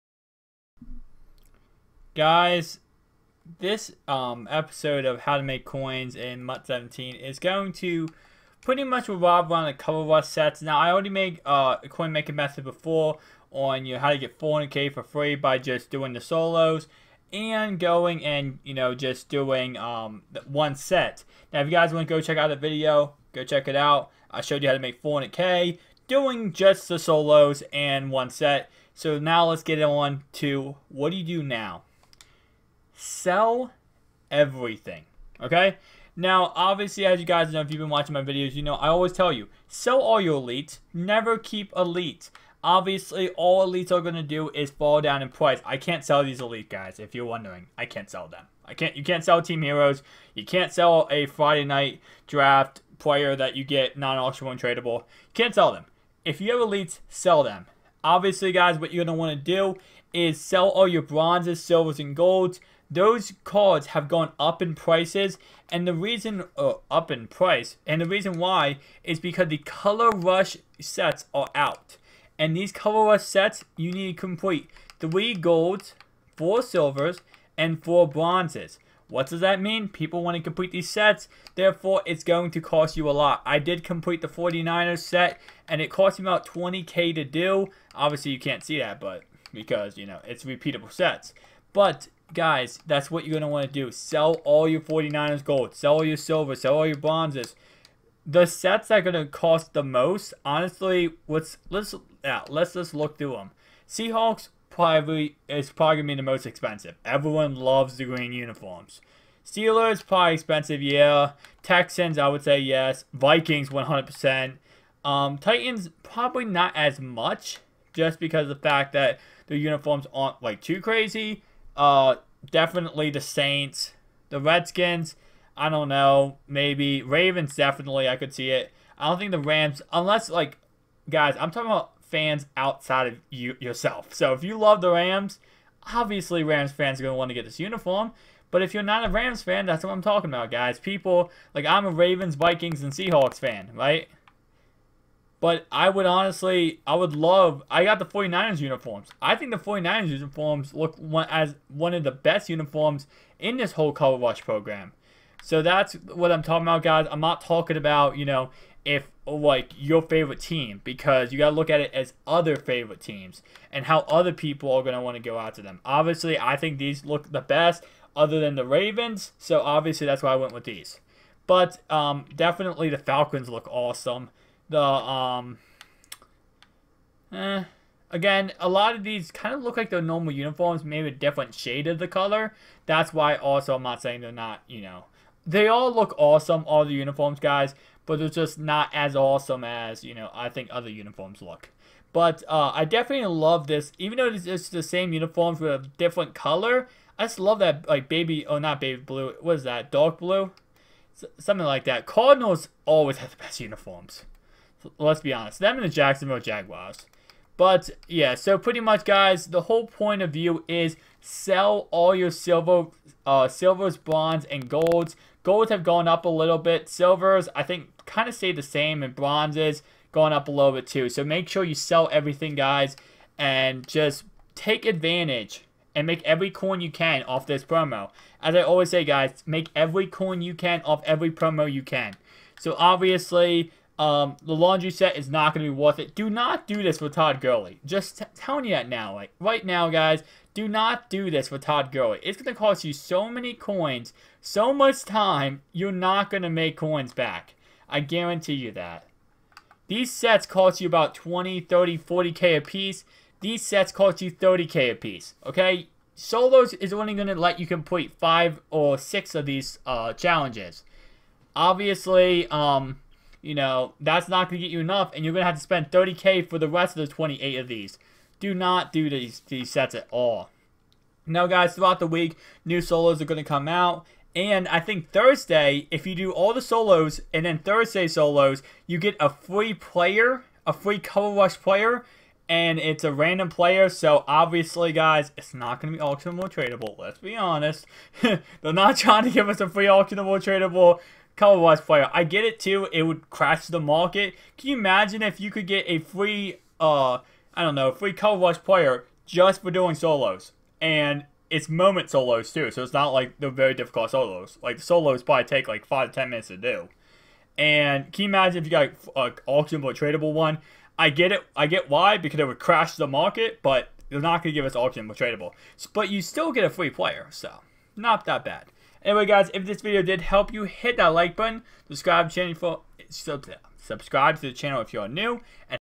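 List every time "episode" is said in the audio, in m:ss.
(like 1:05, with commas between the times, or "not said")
0:04.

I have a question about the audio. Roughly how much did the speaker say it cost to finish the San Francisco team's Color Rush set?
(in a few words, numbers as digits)
20k.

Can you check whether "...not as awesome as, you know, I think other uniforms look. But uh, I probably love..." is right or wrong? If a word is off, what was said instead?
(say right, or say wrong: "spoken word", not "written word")
wrong: "definitely", not "probably".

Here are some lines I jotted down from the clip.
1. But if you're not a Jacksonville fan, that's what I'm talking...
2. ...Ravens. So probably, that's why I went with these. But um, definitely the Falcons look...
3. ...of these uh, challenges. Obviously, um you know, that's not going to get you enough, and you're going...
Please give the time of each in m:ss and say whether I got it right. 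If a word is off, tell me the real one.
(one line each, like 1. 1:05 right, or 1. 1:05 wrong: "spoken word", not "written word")
1. 2:18 wrong: "Rams", not "Jacksonville"
2. 2:48 wrong: "obviously", not "probably"
3. 4:19 right.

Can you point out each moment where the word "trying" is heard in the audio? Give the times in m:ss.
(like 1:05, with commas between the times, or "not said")
4:48.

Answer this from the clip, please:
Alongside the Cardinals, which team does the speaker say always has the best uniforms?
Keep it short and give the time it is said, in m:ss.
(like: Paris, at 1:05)
Jacksonville Jaguars, at 3:25.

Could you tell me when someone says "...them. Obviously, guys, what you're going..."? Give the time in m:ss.
0:57.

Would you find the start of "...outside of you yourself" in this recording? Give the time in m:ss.
2:12.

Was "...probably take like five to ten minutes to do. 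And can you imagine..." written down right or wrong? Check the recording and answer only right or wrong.
right.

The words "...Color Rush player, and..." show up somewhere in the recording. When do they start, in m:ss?
4:40.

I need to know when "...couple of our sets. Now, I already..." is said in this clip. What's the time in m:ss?
0:09.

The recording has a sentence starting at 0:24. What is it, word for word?
I showed you how to make 400k doing just the solos and one set.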